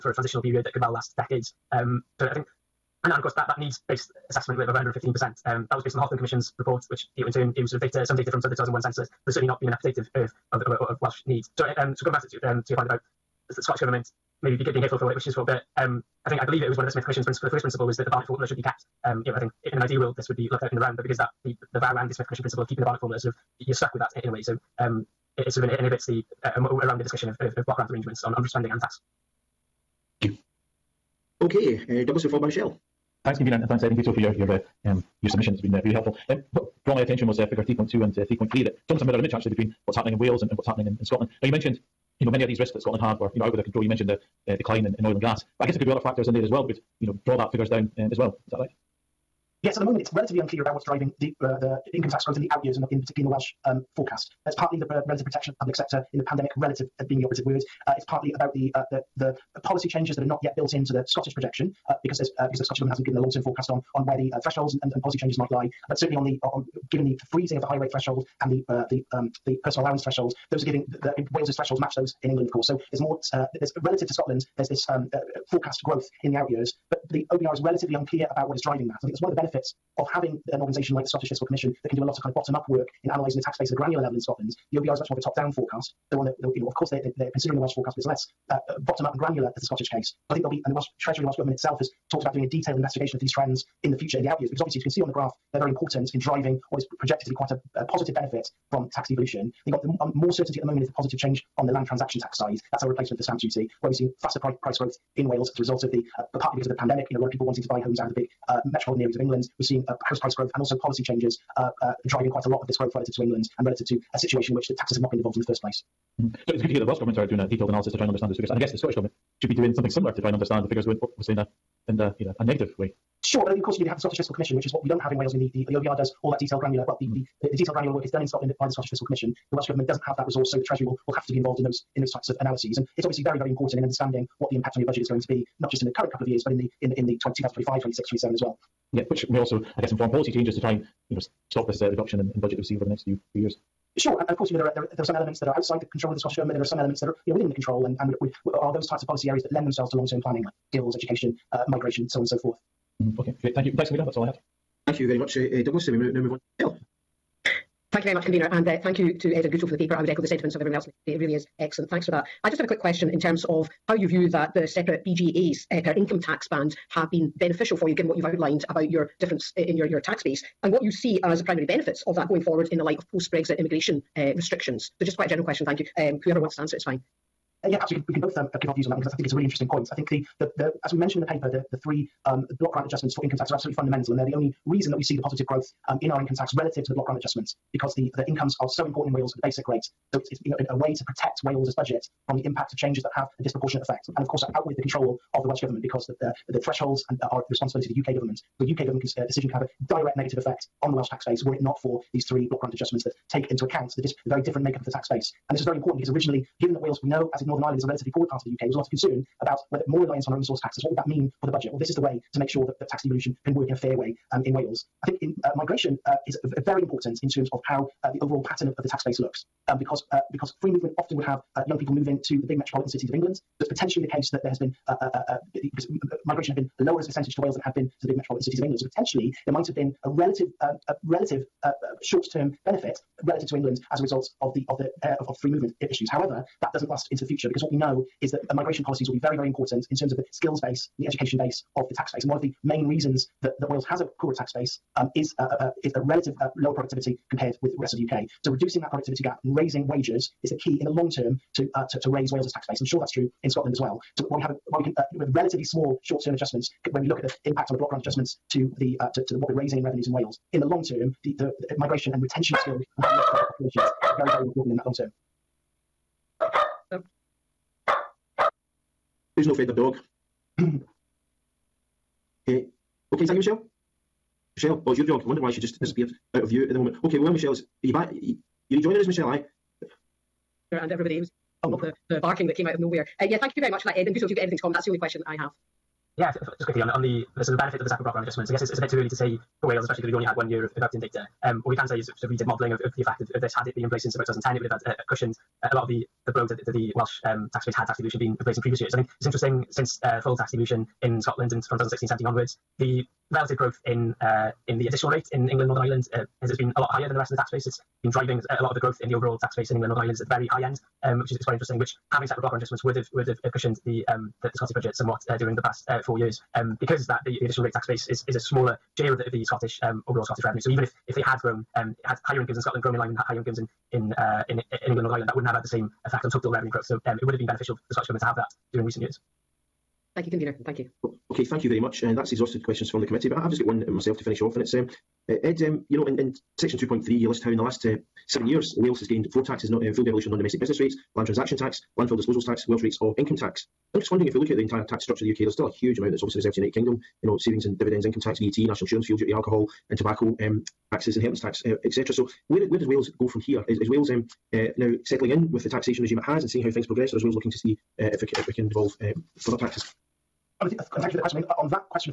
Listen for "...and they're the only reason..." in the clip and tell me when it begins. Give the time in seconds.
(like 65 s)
184 s.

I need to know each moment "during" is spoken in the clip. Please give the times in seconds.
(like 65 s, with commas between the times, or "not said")
315 s, 328 s.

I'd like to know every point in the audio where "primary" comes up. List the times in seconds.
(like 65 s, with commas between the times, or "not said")
171 s.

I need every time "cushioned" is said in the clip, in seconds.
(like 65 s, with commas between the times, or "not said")
295 s, 313 s.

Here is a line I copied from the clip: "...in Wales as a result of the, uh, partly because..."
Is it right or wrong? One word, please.
right.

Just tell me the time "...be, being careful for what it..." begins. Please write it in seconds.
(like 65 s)
14 s.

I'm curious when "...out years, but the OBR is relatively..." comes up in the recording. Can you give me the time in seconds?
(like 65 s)
76 s.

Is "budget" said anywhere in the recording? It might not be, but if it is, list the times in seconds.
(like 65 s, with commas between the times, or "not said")
134 s, 142 s, 191 s, 211 s, 314 s.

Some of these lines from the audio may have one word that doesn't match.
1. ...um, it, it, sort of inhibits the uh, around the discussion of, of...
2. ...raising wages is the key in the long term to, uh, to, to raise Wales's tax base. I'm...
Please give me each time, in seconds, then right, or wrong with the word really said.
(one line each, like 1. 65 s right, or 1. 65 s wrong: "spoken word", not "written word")
1. 24 s right
2. 249 s right.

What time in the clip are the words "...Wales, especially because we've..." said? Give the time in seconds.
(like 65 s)
289 s.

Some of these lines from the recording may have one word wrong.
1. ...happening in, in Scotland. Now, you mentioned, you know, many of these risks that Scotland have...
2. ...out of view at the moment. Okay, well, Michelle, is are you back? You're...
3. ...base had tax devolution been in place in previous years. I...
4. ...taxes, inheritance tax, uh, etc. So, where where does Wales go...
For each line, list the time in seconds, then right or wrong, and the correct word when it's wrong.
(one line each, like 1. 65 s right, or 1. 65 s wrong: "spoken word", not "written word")
1. 40 s right
2. 276 s right
3. 297 s right
4. 350 s right.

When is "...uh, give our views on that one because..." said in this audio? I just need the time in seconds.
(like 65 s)
178 s.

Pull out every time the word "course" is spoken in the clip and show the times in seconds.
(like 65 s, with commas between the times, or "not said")
3 s, 72 s, 86 s, 123 s, 144 s, 194 s.